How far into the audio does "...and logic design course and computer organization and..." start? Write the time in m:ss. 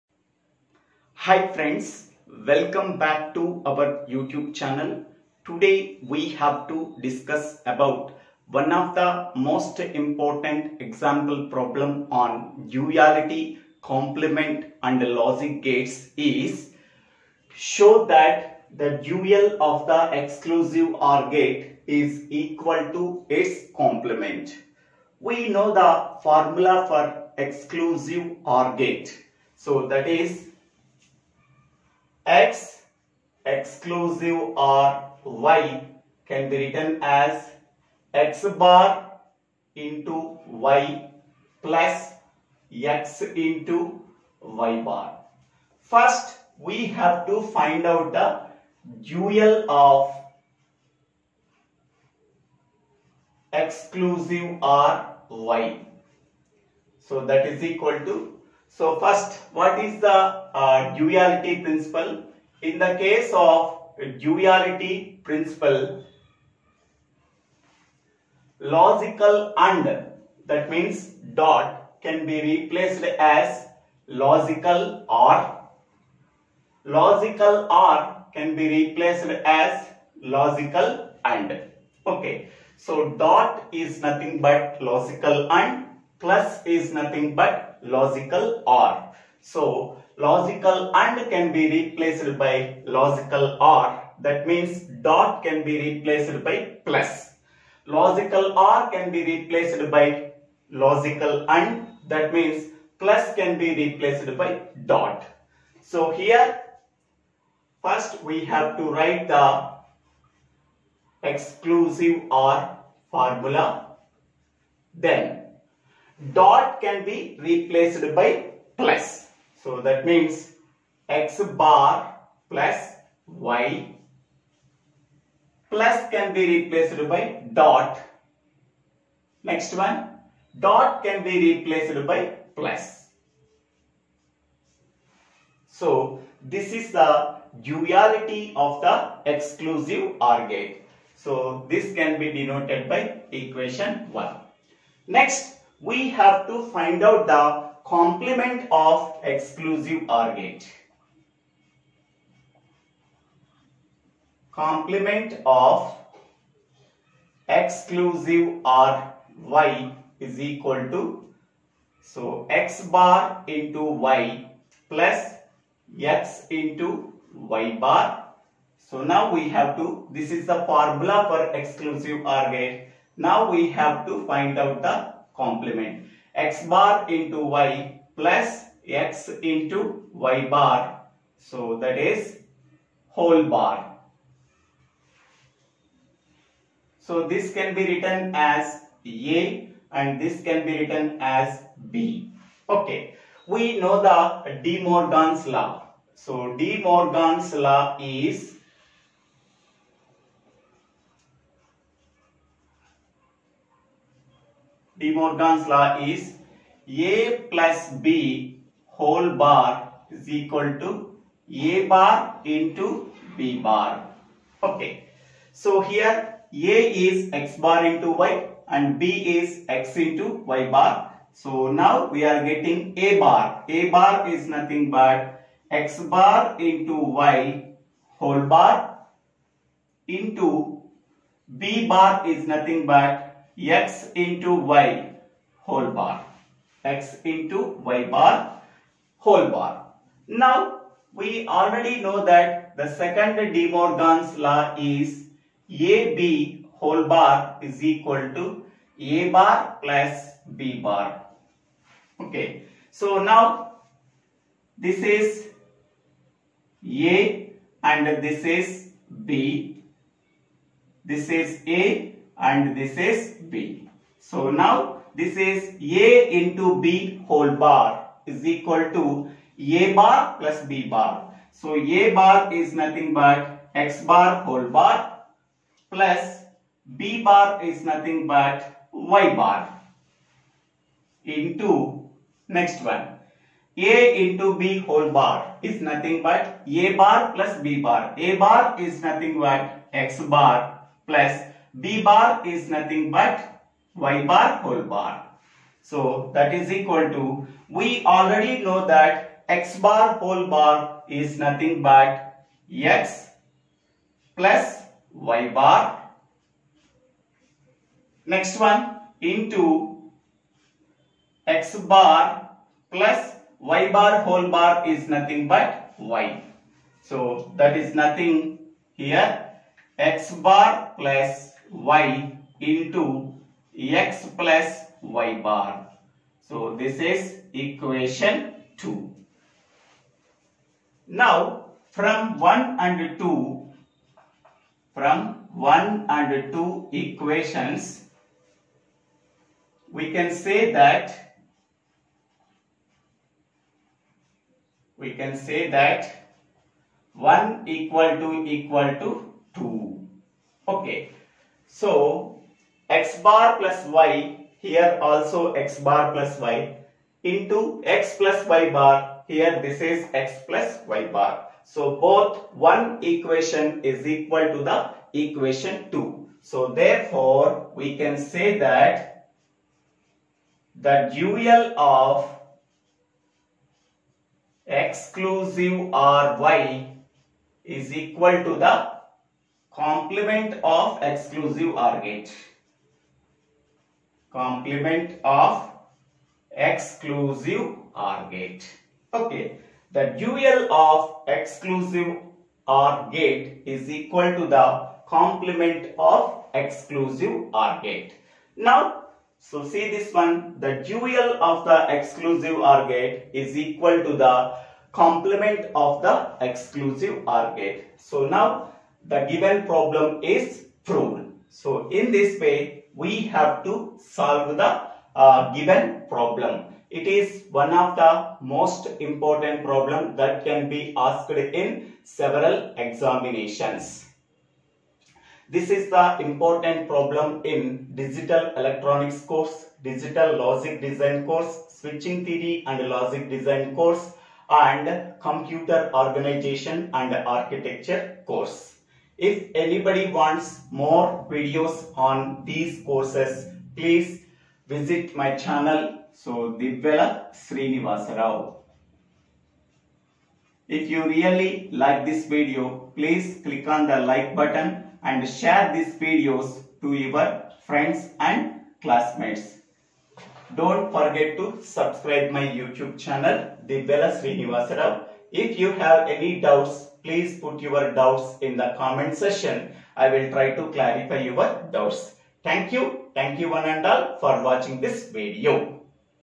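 7:12.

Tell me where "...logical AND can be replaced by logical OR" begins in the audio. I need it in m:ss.
1:30.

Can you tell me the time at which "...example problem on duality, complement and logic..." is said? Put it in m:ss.
0:10.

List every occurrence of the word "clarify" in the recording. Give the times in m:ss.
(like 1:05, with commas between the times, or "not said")
7:50.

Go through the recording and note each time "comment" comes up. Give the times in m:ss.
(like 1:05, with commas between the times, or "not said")
7:48.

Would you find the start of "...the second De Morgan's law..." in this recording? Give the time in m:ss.
4:02.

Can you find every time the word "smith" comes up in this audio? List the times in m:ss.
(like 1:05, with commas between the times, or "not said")
not said.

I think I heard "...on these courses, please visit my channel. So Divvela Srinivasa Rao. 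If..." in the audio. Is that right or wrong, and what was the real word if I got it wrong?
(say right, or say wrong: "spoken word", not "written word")
right.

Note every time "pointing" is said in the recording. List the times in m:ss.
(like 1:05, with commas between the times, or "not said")
not said.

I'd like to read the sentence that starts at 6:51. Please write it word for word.
So in this way, we have to solve the uh, given problem.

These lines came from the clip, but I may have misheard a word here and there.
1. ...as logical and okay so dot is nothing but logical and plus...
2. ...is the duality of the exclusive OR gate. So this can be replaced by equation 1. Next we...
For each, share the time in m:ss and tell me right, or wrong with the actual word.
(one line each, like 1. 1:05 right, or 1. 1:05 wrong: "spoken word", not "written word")
1. 1:19 right
2. 2:16 wrong: "denoted", not "replaced".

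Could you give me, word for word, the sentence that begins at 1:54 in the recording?
Then dot can be replaced by plus.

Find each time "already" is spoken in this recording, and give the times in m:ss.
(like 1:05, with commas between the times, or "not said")
4:01, 4:58.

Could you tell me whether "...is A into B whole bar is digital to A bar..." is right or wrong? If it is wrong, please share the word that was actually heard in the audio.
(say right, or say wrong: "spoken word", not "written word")
wrong: "equal", not "digital".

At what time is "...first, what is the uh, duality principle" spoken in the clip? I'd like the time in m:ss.
0:59.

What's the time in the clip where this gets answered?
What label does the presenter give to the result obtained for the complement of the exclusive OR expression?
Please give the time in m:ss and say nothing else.
5:26.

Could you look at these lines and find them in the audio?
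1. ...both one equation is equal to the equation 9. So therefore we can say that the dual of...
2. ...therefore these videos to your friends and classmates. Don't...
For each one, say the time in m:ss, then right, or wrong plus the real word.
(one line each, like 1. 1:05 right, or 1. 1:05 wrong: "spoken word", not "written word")
1. 6:01 wrong: "2", not "9"
2. 7:35 wrong: "share", not "therefore".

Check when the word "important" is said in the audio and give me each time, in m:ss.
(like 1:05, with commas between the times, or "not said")
0:09, 6:58, 7:06.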